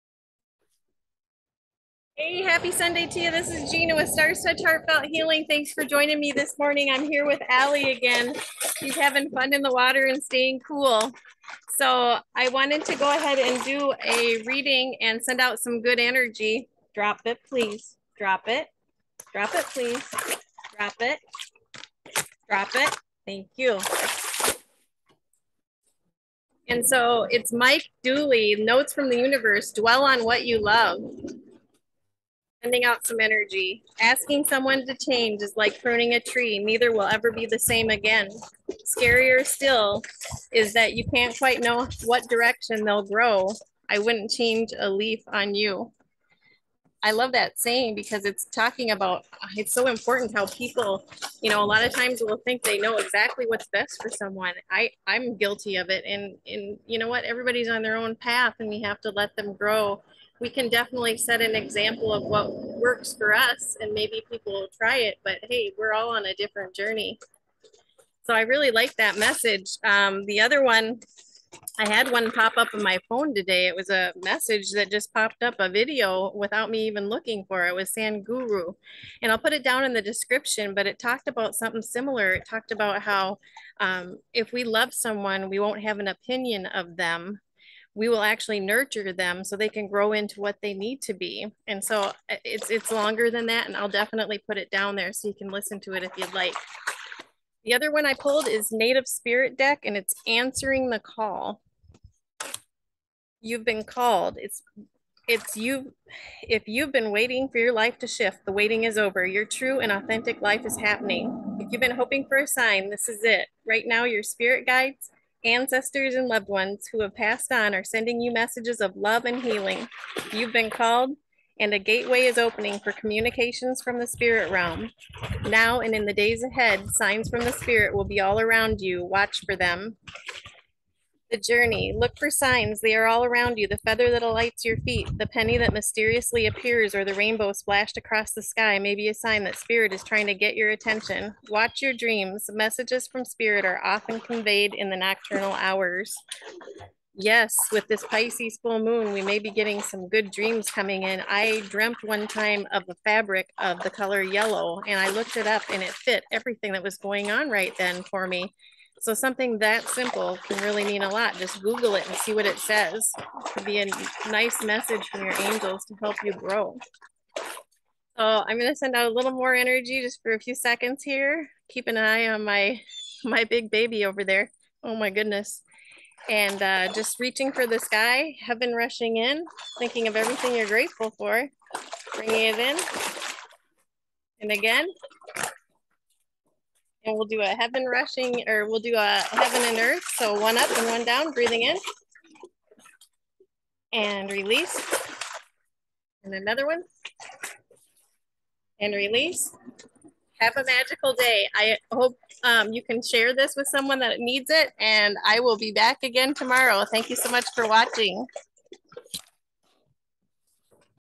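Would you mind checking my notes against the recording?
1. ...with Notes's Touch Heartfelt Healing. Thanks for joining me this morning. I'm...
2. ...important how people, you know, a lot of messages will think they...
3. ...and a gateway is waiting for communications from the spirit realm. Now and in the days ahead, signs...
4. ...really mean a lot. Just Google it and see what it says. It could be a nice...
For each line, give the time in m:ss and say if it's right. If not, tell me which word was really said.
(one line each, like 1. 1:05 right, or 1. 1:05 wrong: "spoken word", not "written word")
1. 0:03 wrong: "Starr", not "Notes"
2. 0:49 wrong: "times", not "messages"
3. 2:01 wrong: "opening", not "waiting"
4. 2:40 right.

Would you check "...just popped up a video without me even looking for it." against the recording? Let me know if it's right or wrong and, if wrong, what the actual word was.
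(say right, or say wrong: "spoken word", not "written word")
right.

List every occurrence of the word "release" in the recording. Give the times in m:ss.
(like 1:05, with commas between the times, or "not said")
3:14, 3:18.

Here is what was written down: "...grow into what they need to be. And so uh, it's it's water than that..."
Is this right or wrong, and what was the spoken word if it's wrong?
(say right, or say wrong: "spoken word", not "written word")
wrong: "longer", not "water".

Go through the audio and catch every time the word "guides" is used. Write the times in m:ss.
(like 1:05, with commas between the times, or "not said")
1:54.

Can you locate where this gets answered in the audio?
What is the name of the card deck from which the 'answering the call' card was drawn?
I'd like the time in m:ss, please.
1:38.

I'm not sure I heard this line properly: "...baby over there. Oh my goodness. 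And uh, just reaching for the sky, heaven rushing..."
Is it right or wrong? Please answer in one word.
right.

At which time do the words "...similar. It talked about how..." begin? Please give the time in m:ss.
1:21.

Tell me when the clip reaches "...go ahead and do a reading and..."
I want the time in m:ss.
0:12.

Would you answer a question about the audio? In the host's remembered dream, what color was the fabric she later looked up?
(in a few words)
Yellow.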